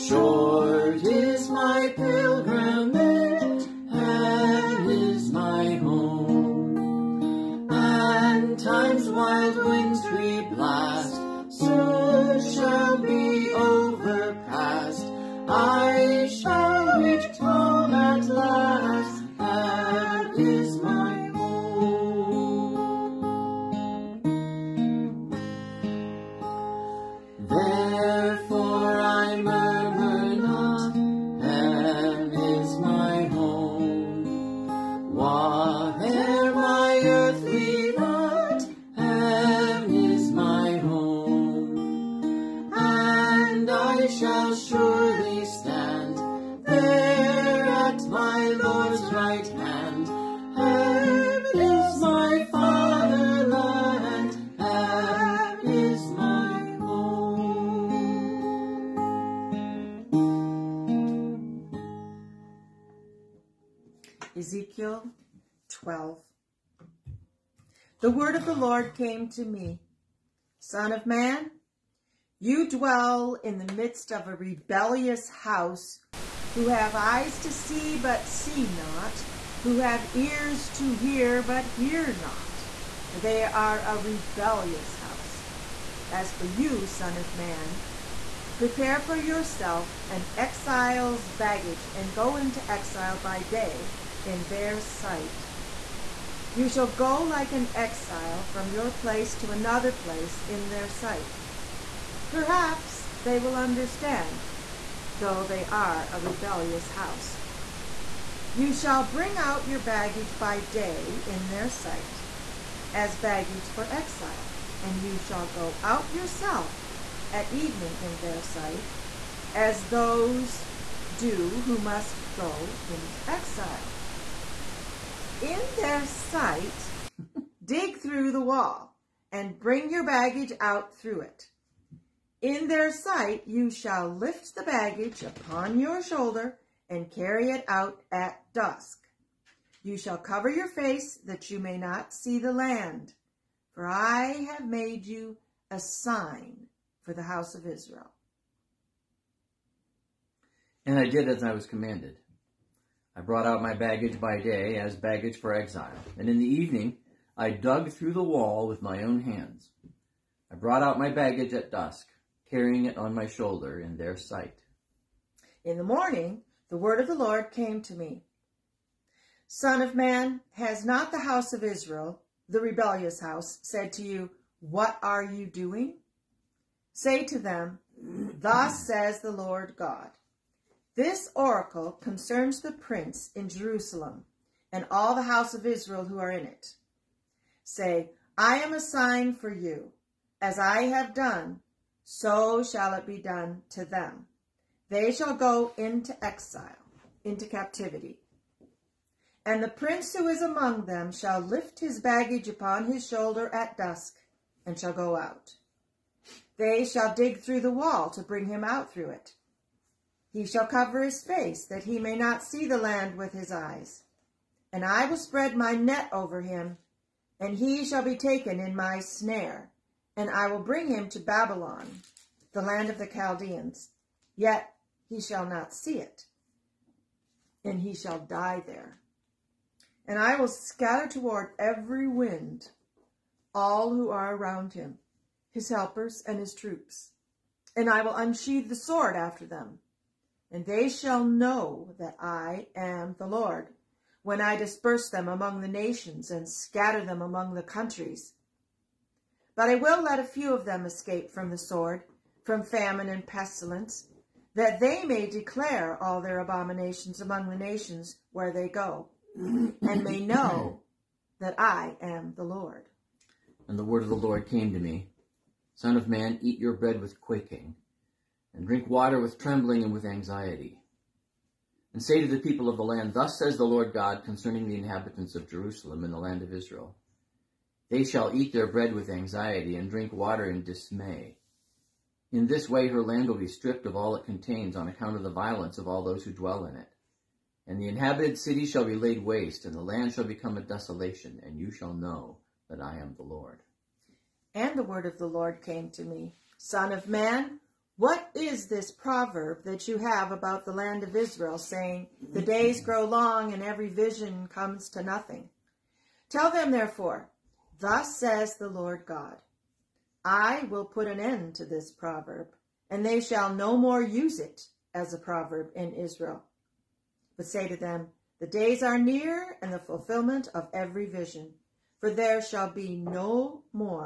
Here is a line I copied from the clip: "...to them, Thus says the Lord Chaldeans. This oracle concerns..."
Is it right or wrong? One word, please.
wrong.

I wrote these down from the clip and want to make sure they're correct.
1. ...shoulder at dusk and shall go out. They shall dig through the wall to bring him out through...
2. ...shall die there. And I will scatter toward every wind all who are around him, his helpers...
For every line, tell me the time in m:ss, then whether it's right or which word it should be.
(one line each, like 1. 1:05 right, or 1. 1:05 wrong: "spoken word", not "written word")
1. 3:23 right
2. 3:47 right.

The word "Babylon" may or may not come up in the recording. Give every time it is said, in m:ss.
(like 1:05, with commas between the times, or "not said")
3:41.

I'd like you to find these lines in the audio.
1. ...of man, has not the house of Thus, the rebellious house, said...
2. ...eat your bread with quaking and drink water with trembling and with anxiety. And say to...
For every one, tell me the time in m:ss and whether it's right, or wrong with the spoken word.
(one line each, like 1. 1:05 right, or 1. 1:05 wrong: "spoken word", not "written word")
1. 2:49 wrong: "Israel", not "Thus"
2. 4:26 right.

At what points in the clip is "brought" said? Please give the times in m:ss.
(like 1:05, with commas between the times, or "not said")
2:33, 2:40.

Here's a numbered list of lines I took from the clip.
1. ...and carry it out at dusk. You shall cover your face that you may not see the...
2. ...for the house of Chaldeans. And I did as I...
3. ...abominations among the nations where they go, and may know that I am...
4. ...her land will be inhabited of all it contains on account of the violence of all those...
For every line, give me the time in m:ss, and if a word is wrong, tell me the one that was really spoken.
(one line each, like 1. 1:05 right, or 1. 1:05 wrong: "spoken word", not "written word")
1. 2:16 right
2. 2:27 wrong: "Israel", not "Chaldeans"
3. 4:16 right
4. 4:42 wrong: "stripped", not "inhabited".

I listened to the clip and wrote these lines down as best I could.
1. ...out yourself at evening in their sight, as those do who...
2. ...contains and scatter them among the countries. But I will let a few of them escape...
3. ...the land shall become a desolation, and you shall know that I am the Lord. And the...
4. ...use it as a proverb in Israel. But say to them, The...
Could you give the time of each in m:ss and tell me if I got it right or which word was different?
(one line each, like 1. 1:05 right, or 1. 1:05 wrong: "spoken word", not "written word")
1. 1:55 right
2. 4:05 wrong: "nations", not "contains"
3. 4:49 right
4. 5:14 right.